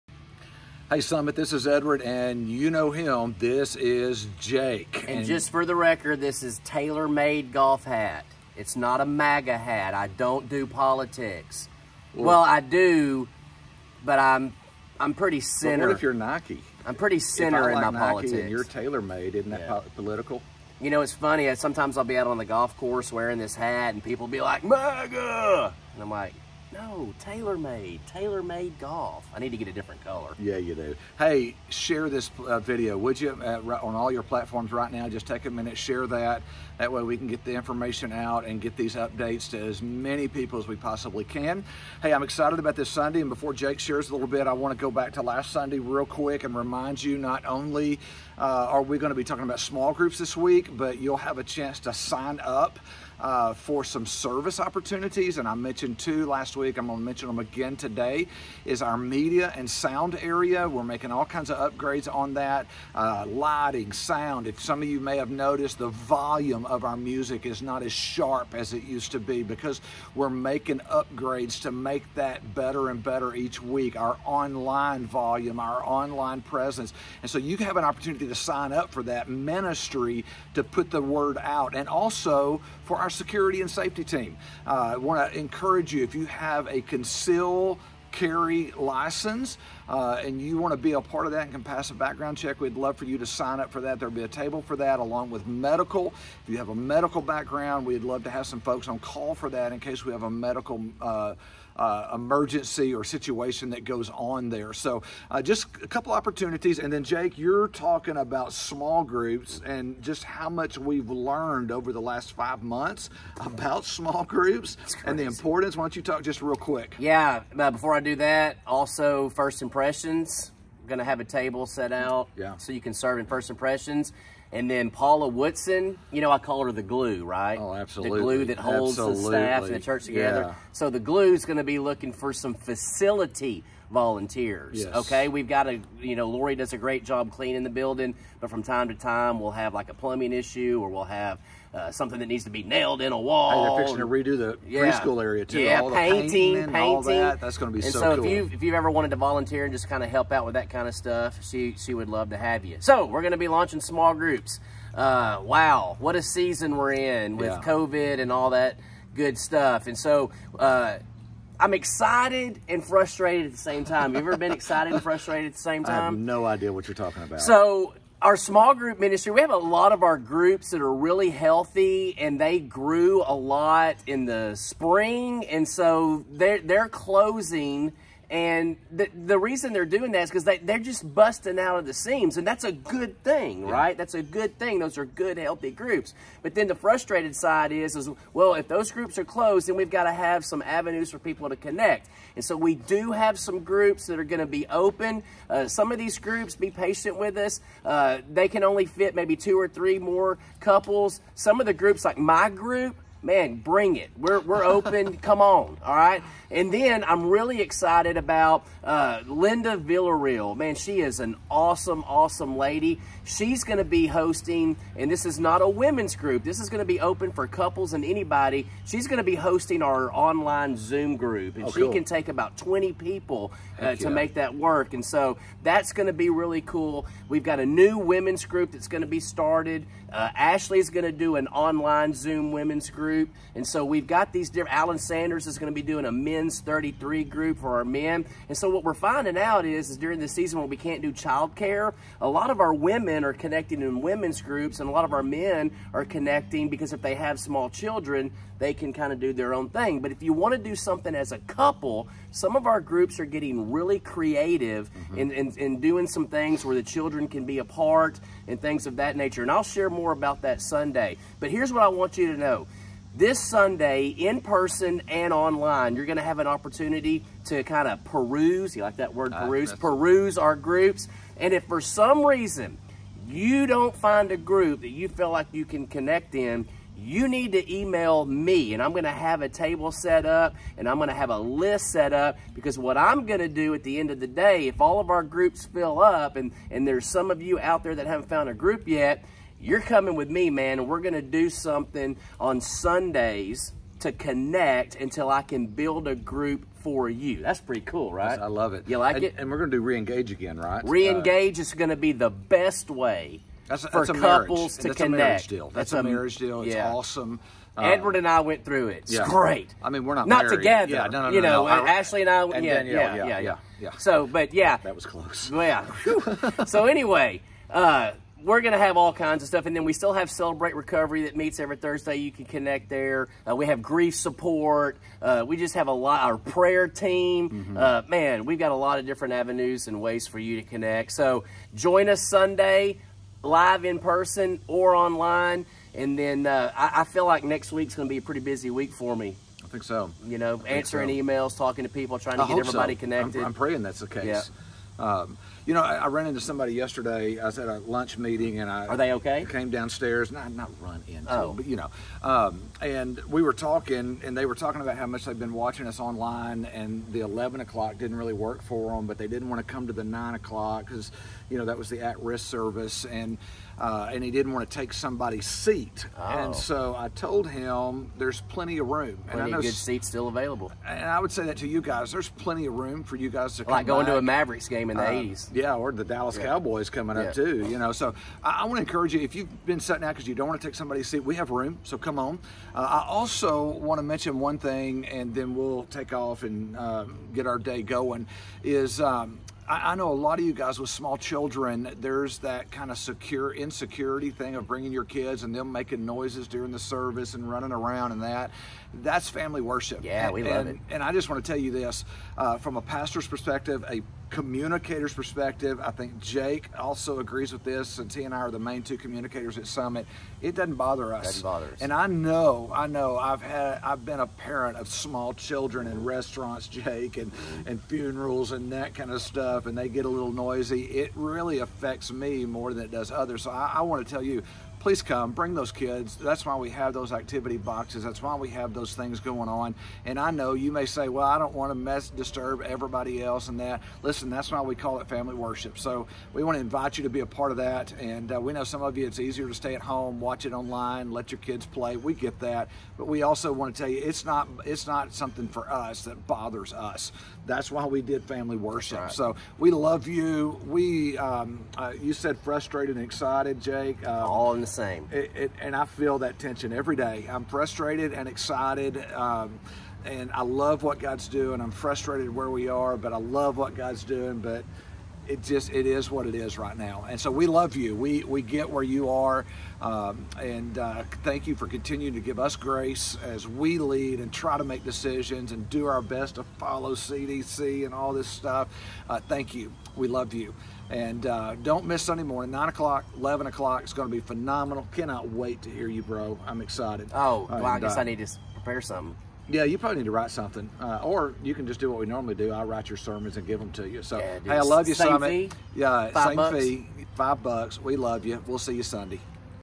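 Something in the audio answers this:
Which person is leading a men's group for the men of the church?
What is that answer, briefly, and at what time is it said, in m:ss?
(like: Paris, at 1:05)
Alan Sanders, at 3:54.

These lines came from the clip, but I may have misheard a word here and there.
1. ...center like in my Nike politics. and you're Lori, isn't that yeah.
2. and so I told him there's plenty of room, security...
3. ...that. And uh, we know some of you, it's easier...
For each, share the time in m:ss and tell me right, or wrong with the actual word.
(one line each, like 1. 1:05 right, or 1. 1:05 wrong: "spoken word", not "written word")
1. 0:17 wrong: "TaylorMade", not "Lori"
2. 6:06 wrong: "plenty", not "security"
3. 7:17 right.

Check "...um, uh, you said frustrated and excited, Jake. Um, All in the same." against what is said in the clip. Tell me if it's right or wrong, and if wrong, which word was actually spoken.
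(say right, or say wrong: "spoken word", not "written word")
right.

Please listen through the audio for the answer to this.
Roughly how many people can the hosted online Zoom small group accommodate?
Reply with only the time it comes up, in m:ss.
3:42.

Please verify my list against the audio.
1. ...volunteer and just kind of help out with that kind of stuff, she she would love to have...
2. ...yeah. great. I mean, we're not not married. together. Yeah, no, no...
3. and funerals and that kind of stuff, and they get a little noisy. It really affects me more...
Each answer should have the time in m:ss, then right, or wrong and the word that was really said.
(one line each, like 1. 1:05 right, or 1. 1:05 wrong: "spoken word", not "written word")
1. 2:29 right
2. 5:09 right
3. 6:57 right.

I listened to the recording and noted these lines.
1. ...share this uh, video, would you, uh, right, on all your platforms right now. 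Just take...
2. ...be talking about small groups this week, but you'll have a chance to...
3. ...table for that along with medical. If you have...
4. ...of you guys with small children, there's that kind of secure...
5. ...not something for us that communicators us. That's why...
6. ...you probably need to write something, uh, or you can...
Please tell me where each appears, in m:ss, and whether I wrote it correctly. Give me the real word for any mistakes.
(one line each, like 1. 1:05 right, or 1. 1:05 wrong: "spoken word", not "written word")
1. 0:31 right
2. 0:49 right
3. 1:34 right
4. 6:30 right
5. 7:24 wrong: "bothers", not "communicators"
6. 8:09 right.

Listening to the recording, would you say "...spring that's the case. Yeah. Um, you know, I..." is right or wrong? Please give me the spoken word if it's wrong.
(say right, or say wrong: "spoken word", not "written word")
wrong: "praying", not "spring".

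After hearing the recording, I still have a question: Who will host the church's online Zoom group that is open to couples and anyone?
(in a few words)
Linda Villarreal.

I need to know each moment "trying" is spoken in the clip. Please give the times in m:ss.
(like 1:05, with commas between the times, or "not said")
5:42.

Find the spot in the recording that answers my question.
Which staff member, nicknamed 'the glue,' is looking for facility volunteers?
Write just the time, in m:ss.
2:04.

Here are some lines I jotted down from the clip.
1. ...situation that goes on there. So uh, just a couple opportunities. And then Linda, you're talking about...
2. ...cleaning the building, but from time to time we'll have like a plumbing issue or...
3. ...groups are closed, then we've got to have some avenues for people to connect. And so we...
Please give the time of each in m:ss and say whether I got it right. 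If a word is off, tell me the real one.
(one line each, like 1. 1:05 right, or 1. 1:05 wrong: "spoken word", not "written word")
1. 1:43 wrong: "Jake", not "Linda"
2. 2:17 right
3. 3:08 right.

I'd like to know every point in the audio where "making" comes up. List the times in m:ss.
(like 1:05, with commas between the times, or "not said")
1:00, 1:10, 6:35.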